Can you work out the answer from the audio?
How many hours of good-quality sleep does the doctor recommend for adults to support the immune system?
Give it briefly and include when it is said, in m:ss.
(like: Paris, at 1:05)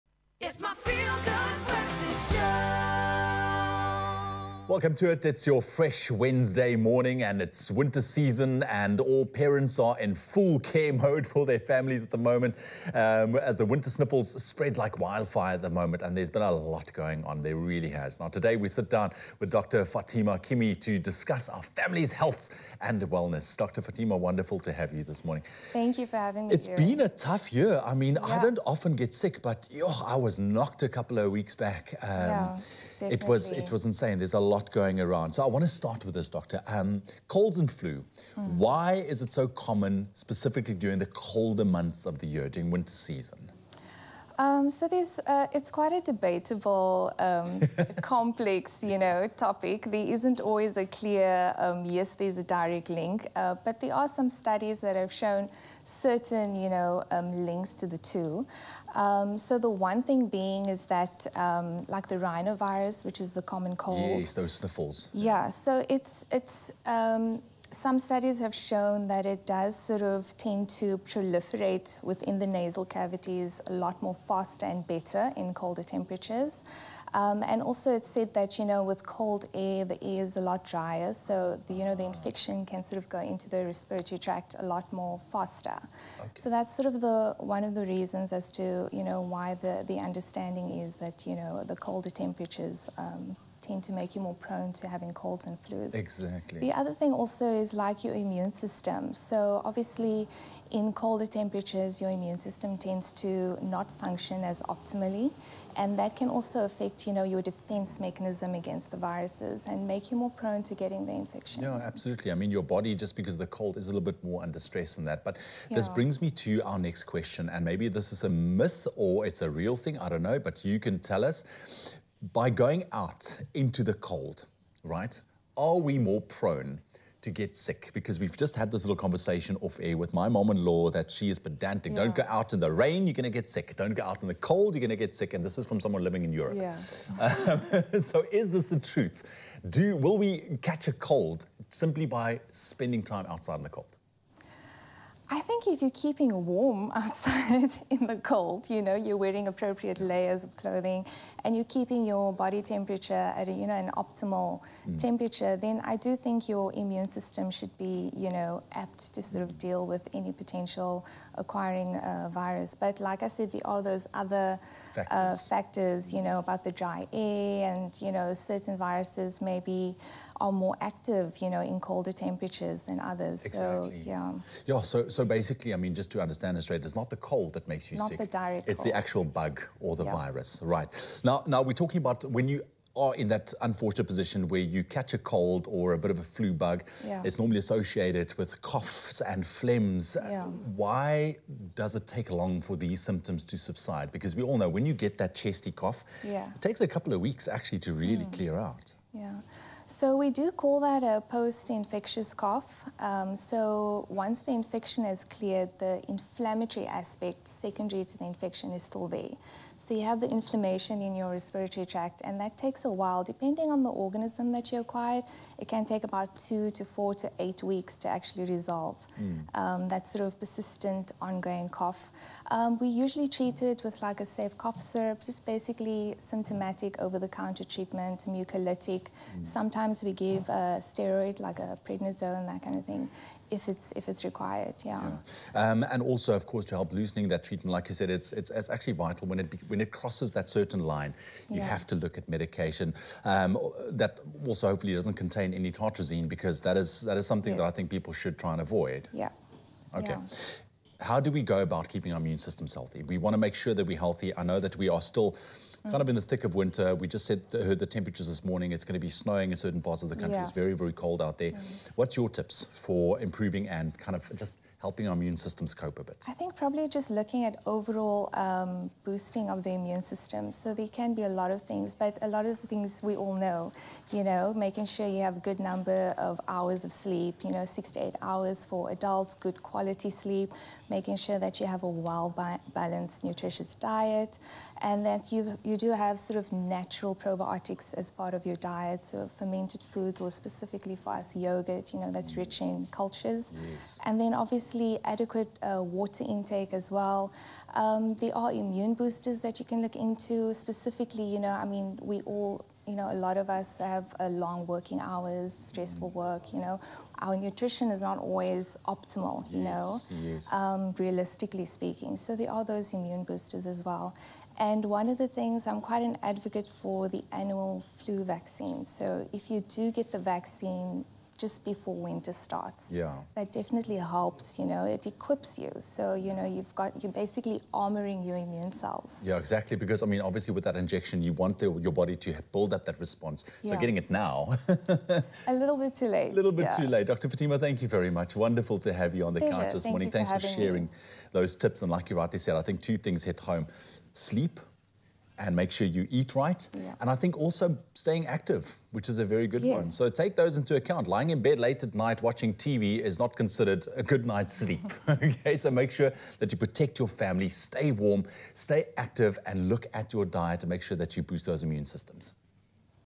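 6 to 8 hours, at 4:37.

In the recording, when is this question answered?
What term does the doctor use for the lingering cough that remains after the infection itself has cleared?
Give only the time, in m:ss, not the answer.
3:21.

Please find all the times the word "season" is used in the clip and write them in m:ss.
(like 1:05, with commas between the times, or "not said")
0:08, 0:42.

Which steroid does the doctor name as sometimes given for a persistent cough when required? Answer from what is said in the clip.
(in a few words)
prednisone.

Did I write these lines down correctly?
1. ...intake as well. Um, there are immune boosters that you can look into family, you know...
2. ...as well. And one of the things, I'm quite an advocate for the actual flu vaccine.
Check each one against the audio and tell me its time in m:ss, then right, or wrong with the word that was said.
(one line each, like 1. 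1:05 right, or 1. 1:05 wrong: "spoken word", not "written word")
1. 4:56 wrong: "specifically", not "family"
2. 5:13 wrong: "annual", not "actual".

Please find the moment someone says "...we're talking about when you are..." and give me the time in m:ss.
3:01.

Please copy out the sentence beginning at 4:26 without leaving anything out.
I think probably just looking at overall um, boosting of the immune system.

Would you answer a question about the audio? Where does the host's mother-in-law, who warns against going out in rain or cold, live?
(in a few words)
Europe.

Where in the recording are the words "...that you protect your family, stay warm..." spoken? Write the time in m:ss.
5:56.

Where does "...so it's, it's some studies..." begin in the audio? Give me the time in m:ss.
1:05.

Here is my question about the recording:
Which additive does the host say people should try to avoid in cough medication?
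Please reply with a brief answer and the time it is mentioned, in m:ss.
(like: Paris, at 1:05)
tartrazine, at 4:05.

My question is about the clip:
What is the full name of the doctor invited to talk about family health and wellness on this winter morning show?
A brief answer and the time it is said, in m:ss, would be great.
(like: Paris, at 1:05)
Fatima Kimi, at 0:19.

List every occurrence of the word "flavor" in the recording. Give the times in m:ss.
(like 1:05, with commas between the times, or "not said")
not said.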